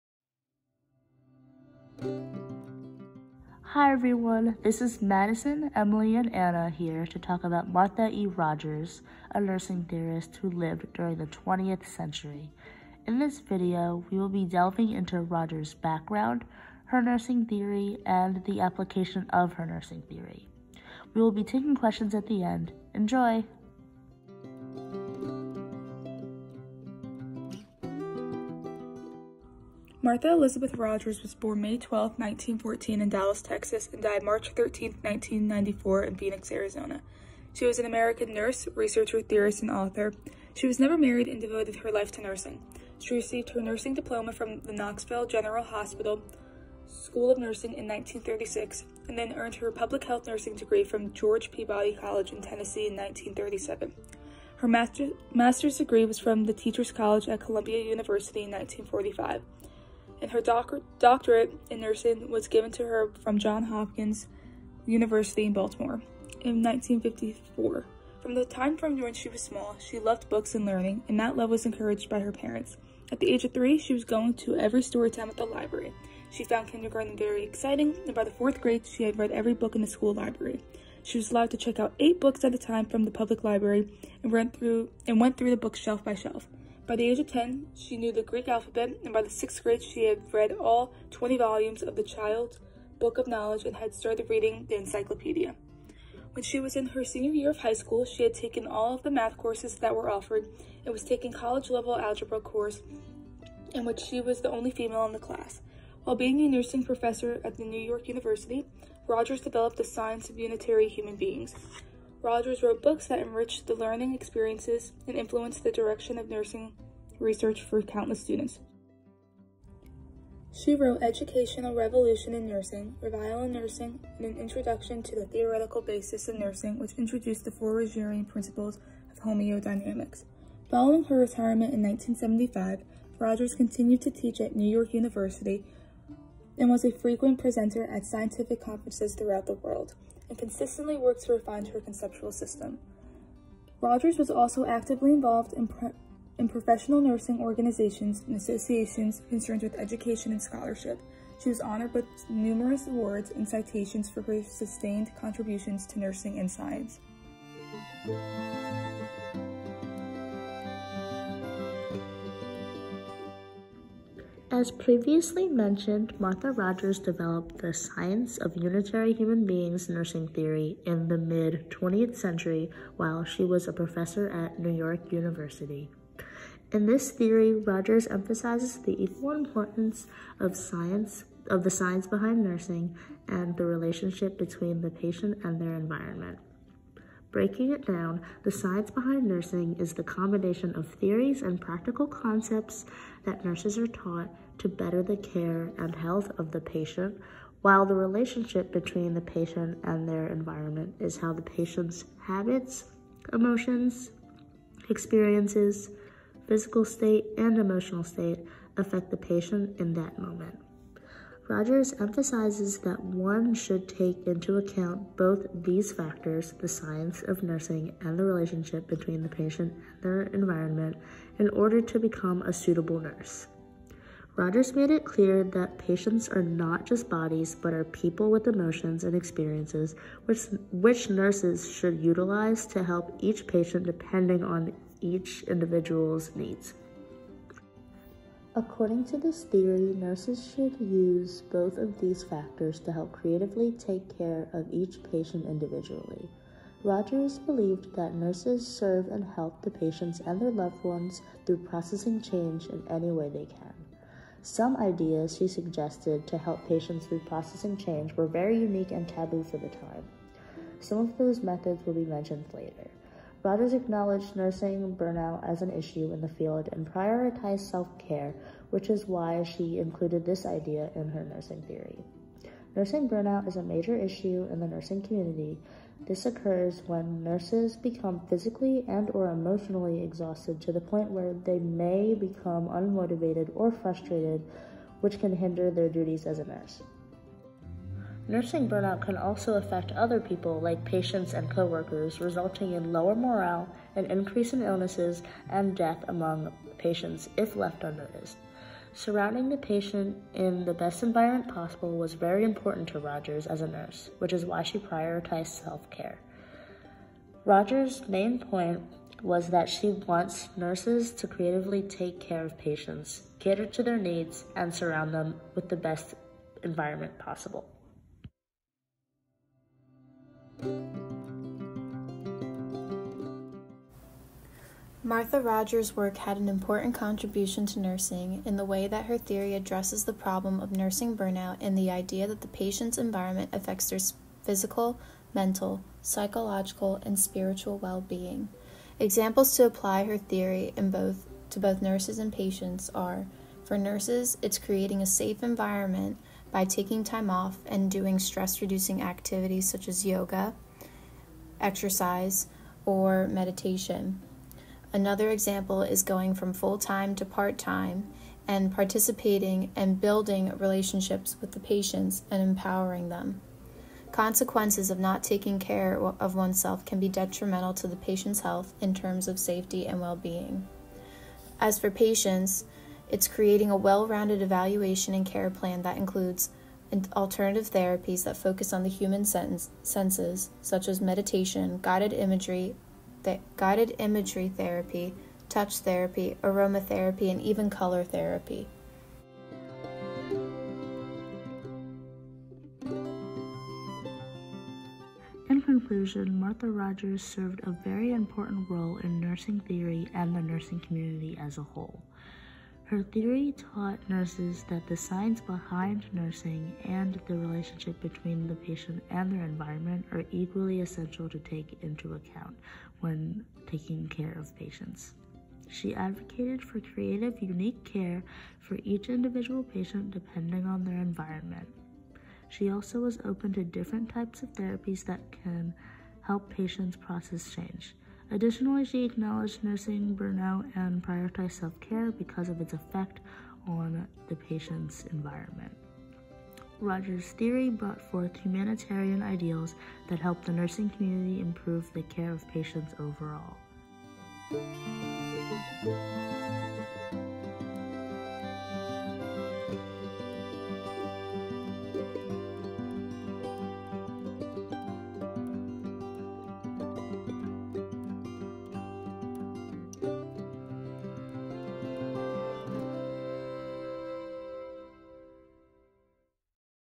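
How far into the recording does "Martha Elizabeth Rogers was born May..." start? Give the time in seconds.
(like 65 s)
30 s.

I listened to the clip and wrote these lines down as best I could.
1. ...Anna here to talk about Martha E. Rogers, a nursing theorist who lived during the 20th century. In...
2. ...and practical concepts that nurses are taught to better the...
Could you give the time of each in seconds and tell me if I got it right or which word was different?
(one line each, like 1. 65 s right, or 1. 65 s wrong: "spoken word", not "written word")
1. 6 s right
2. 191 s right.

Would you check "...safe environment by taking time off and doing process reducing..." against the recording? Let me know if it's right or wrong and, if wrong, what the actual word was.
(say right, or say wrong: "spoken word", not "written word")
wrong: "stress", not "process".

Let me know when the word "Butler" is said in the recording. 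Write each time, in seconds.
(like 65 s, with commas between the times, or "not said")
not said.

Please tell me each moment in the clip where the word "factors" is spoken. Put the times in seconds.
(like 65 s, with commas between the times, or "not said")
215 s, 242 s.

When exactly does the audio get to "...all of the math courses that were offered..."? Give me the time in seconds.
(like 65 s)
98 s.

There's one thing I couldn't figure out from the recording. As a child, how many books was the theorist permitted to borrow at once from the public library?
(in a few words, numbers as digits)
8.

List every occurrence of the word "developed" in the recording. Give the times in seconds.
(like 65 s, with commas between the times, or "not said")
109 s, 166 s.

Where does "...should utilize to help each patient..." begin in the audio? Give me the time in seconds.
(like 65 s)
231 s.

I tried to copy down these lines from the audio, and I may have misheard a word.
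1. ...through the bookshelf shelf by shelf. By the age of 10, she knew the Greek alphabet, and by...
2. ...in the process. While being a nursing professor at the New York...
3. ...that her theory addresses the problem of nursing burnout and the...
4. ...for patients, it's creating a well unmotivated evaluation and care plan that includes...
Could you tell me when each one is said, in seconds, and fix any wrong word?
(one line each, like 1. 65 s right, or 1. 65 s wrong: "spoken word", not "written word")
1. 85 s right
2. 105 s wrong: "class", not "process"
3. 328 s right
4. 371 s wrong: "rounded", not "unmotivated".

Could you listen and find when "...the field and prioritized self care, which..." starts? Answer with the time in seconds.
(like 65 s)
266 s.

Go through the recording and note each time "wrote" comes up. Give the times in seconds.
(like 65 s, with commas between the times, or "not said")
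112 s, 120 s.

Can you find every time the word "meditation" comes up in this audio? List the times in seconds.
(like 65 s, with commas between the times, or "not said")
353 s, 381 s.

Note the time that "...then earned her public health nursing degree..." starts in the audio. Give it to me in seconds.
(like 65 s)
49 s.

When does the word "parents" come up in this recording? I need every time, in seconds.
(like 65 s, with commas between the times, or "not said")
72 s.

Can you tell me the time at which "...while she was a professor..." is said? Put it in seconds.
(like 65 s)
172 s.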